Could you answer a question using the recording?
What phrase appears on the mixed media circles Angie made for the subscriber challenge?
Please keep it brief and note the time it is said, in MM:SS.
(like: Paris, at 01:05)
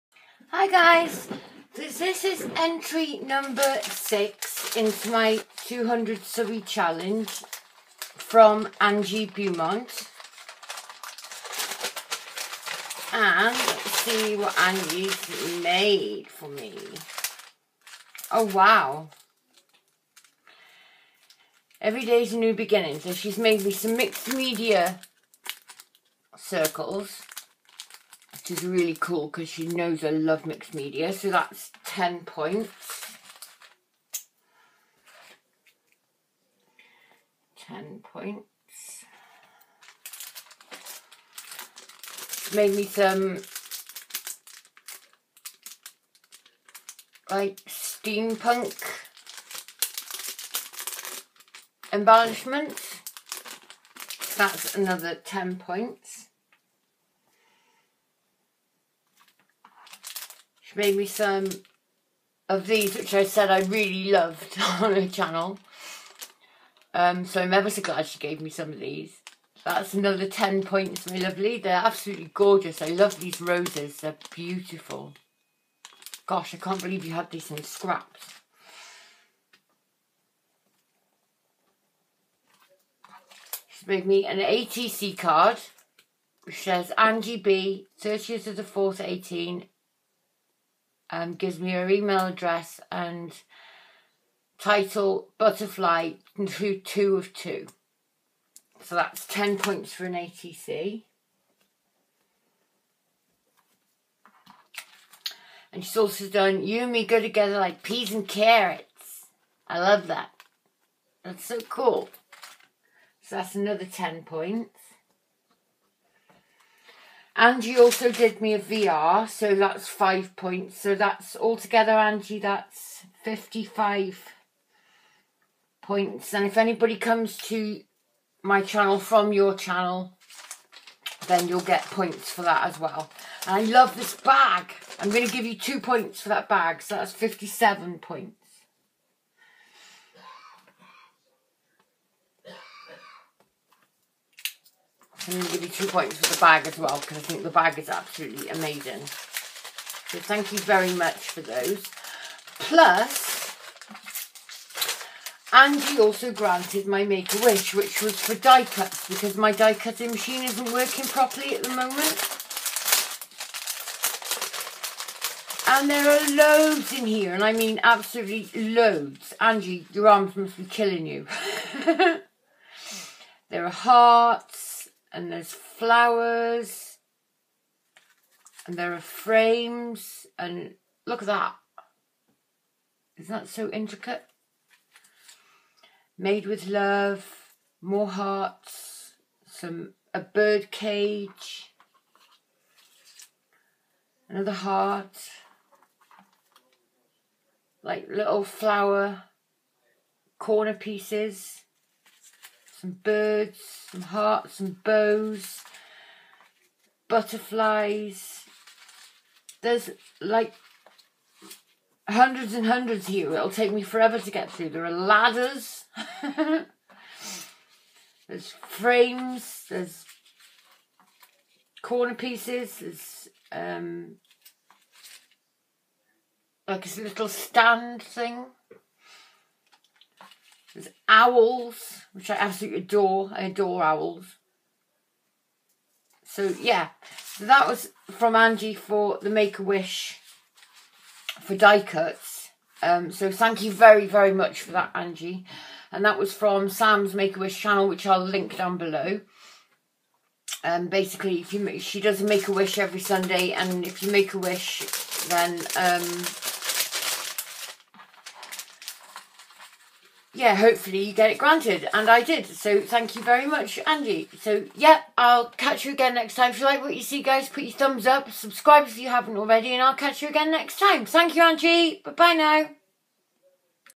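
Every day's a new beginning, at 00:21.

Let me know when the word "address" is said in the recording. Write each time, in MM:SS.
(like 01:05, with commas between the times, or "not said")
01:32.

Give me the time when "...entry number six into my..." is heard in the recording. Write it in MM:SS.
00:02.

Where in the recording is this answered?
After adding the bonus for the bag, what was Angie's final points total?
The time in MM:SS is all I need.
02:17.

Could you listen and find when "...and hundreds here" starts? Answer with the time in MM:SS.
03:32.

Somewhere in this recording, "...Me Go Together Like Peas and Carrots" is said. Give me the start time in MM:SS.
01:46.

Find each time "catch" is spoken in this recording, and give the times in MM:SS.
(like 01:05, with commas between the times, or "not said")
04:25, 04:29.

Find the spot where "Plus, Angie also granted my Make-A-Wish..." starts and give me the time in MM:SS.
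02:32.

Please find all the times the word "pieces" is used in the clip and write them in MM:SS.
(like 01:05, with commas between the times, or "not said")
03:20, 03:42.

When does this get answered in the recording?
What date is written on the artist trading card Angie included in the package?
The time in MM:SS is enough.
01:28.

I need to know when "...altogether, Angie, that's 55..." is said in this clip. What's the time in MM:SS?
02:01.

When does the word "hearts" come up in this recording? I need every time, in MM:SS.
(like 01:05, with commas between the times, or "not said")
02:53, 03:08, 03:14, 03:24.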